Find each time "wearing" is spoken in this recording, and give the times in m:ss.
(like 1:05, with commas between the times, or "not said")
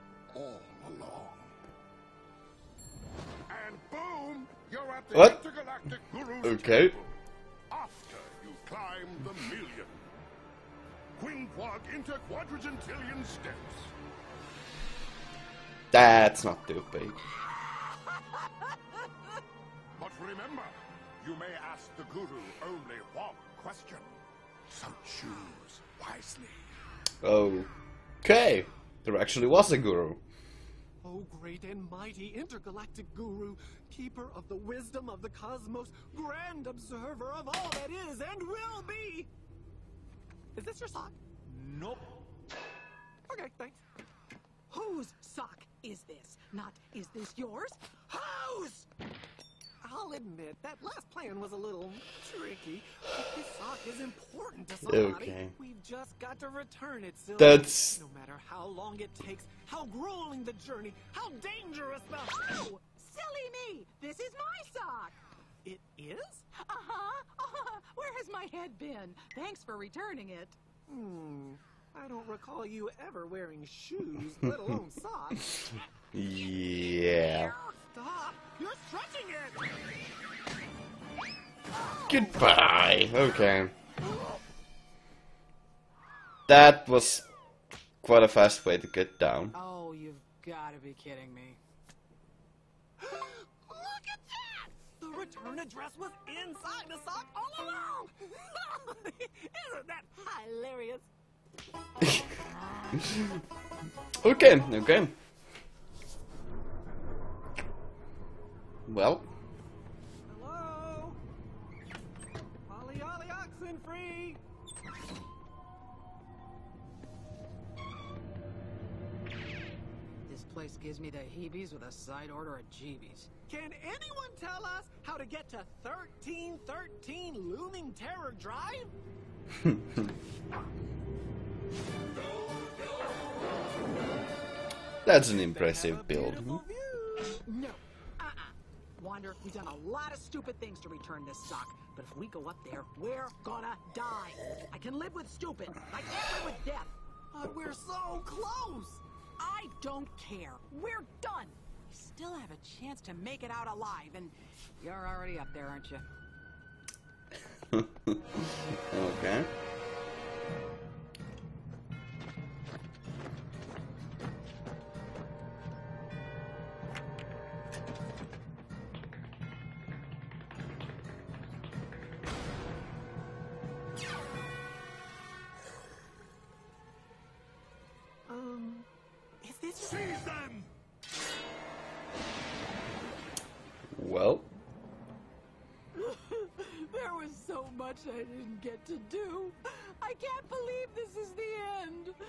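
1:13.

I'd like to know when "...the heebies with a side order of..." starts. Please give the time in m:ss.
2:01.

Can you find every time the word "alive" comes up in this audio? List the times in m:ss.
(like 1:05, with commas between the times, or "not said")
2:33.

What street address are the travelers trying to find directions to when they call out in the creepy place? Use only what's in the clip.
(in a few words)
1313 Looming Terror Drive.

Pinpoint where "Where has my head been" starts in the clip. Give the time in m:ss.
1:07.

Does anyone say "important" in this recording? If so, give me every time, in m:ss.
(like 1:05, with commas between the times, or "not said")
0:53.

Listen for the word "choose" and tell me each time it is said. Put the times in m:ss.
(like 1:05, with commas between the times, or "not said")
0:25.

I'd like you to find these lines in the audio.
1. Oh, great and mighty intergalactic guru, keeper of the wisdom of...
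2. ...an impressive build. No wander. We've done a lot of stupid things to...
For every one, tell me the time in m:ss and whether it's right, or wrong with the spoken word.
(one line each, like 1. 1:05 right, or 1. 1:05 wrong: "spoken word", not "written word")
1. 0:31 right
2. 2:15 right.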